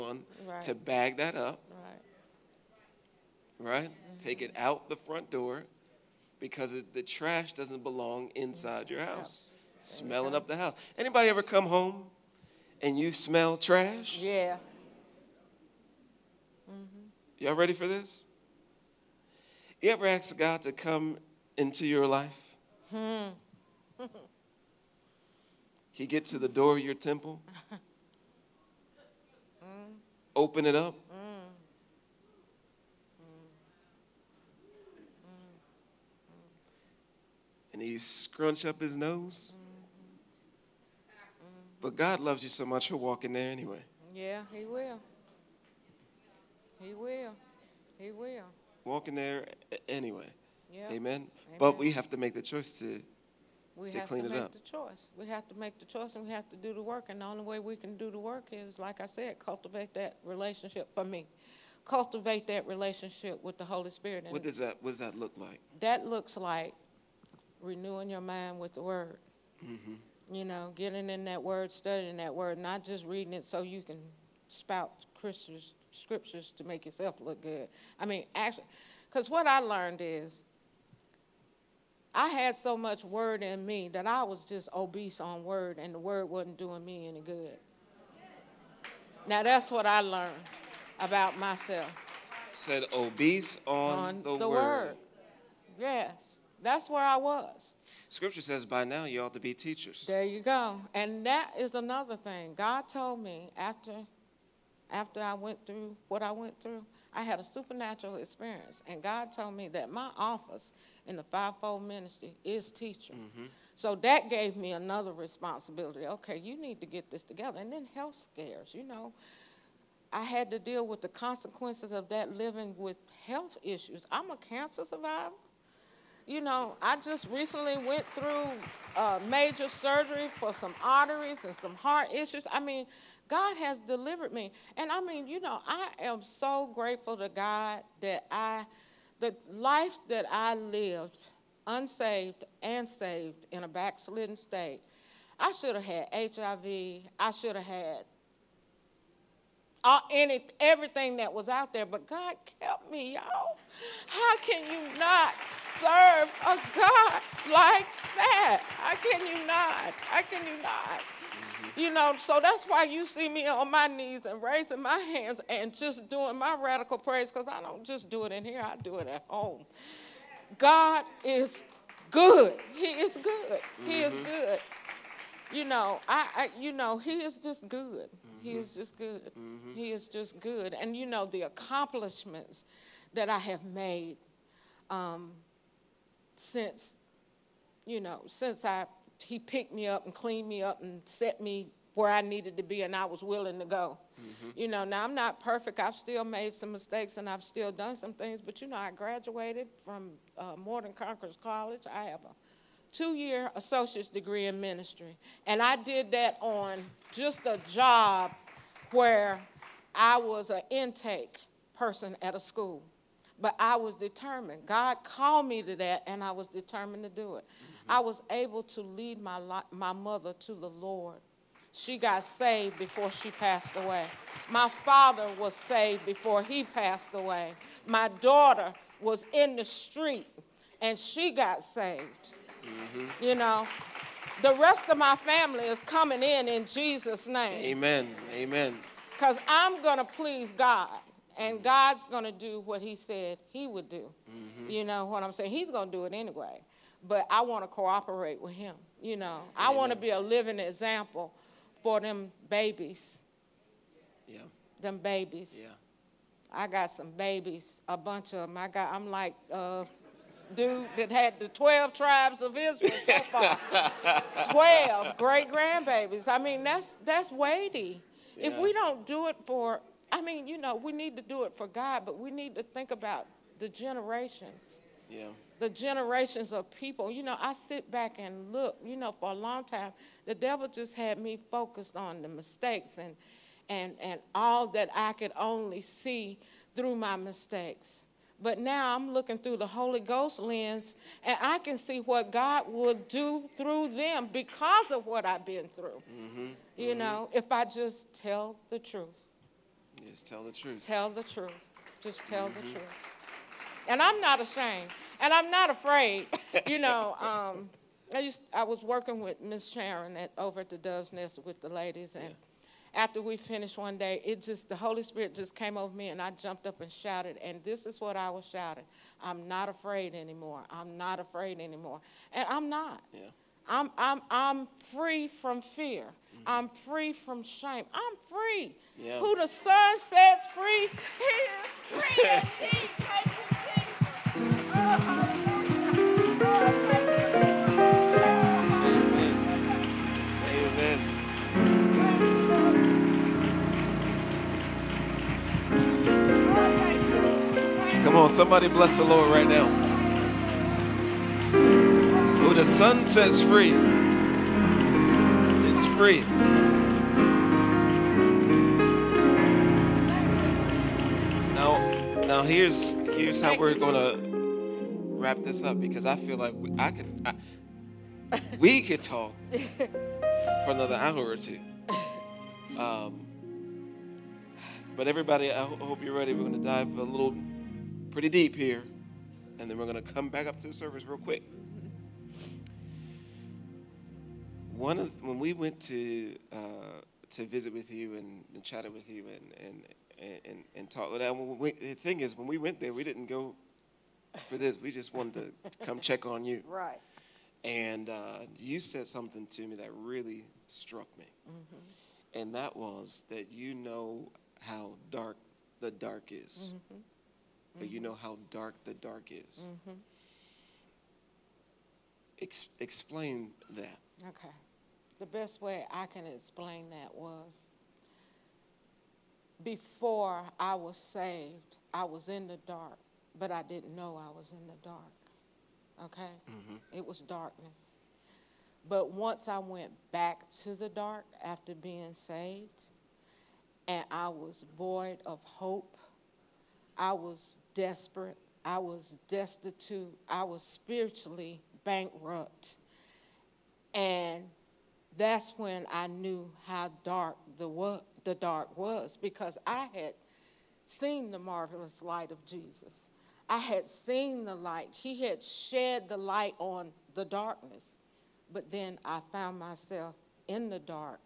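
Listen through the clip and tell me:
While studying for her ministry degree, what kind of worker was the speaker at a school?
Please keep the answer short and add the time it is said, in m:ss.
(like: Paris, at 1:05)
Intake person, at 3:30.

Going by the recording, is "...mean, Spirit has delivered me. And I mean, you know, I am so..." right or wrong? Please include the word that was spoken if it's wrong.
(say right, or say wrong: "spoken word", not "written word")
wrong: "God", not "Spirit".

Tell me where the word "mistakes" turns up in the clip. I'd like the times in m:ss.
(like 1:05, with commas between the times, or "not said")
3:16, 4:42, 4:47.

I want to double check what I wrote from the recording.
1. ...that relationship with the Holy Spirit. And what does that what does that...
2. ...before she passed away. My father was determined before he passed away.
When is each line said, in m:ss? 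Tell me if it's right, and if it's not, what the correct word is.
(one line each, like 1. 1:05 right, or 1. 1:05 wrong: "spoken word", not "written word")
1. 1:02 right
2. 3:42 wrong: "saved", not "determined".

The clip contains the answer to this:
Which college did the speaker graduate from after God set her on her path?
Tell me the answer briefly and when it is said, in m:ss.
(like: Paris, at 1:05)
Morton Conquerors College, at 3:20.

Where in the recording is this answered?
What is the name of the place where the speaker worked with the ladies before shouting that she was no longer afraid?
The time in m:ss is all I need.
5:10.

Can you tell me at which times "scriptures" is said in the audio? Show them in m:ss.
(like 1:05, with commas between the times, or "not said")
1:15, 1:38.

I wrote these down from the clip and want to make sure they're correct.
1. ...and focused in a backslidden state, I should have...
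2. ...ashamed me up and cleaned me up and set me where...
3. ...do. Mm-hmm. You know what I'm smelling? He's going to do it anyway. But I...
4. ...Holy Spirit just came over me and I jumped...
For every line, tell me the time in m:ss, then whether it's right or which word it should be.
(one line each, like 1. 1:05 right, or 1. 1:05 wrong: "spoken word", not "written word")
1. 2:22 wrong: "saved", not "focused"
2. 3:09 wrong: "picked", not "ashamed"
3. 4:03 wrong: "saying", not "smelling"
4. 5:14 right.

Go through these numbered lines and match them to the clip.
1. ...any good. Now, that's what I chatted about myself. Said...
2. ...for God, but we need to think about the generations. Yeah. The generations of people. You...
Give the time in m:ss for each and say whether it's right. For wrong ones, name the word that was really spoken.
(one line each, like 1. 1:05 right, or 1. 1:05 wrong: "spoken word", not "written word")
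1. 1:27 wrong: "learned", not "chatted"
2. 4:31 right.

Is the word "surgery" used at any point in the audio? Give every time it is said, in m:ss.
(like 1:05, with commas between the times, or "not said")
2:09.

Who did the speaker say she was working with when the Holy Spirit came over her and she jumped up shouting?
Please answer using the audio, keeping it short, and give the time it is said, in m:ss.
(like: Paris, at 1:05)
Miss Sharon, at 5:09.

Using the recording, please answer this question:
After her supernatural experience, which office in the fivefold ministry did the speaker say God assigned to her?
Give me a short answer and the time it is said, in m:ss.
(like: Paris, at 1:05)
Teacher, at 1:52.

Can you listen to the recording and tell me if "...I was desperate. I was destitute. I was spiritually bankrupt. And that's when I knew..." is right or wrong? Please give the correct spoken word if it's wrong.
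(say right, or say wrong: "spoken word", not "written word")
right.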